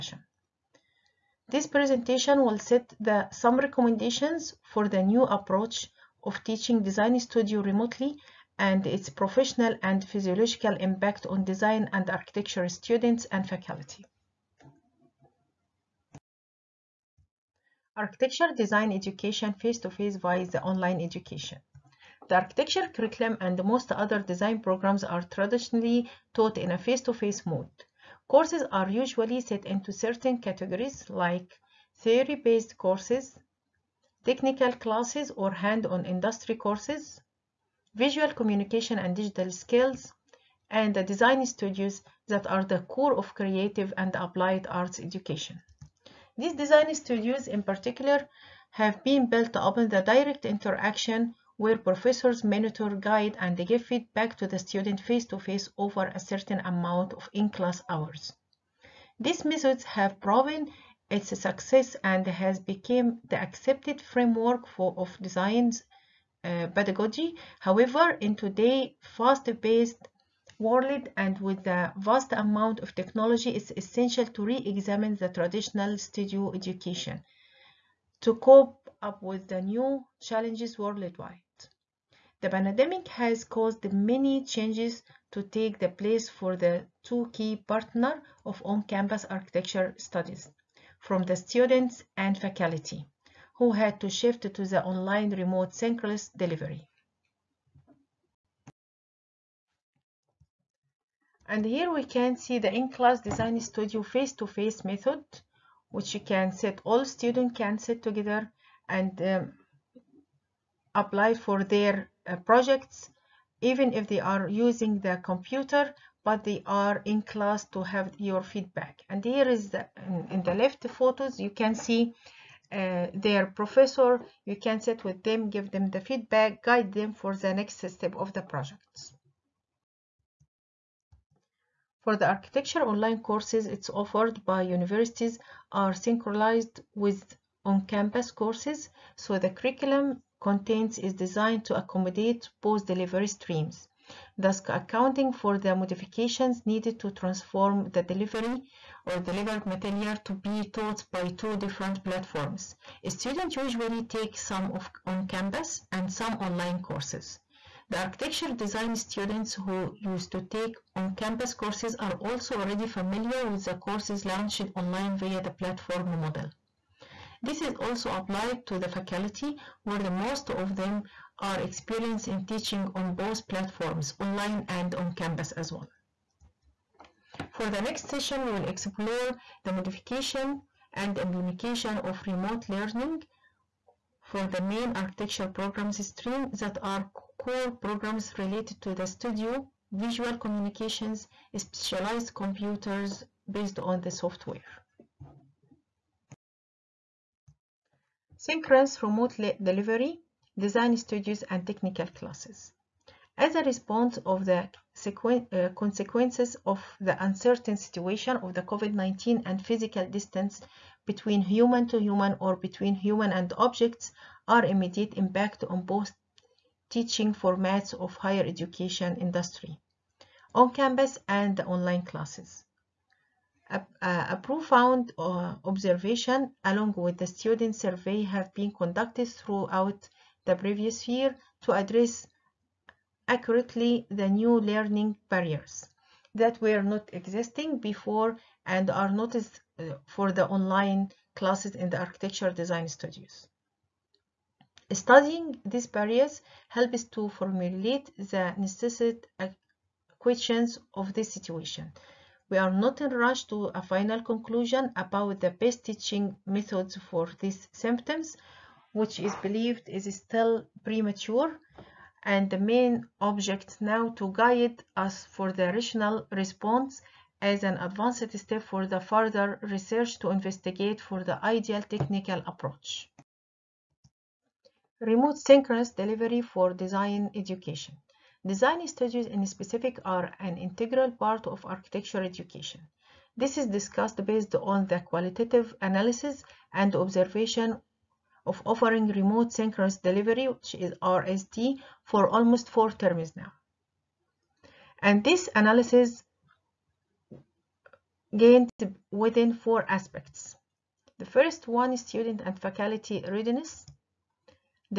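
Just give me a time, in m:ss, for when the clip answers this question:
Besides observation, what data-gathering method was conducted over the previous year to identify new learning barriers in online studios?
3:47.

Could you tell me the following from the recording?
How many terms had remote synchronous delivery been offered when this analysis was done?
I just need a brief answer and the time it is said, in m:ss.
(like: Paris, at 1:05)
4 terms, at 4:52.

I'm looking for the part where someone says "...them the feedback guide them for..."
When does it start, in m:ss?
2:05.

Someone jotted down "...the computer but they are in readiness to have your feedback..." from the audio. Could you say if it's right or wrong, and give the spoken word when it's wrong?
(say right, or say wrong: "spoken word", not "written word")
wrong: "class", not "readiness".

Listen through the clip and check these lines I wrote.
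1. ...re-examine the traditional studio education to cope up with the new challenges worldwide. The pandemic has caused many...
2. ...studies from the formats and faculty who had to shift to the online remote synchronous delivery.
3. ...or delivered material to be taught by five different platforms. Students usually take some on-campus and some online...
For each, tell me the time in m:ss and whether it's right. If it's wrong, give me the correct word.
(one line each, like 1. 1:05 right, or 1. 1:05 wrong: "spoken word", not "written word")
1. 1:14 right
2. 1:30 wrong: "students", not "formats"
3. 2:29 wrong: "two", not "five".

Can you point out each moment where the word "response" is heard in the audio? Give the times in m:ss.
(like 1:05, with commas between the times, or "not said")
3:23, 4:26.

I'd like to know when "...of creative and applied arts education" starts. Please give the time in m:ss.
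0:43.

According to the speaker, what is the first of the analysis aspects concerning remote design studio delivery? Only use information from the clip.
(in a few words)
student and faculty readiness.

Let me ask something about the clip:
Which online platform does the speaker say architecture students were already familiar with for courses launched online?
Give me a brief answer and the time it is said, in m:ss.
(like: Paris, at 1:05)
Moodle, at 2:46.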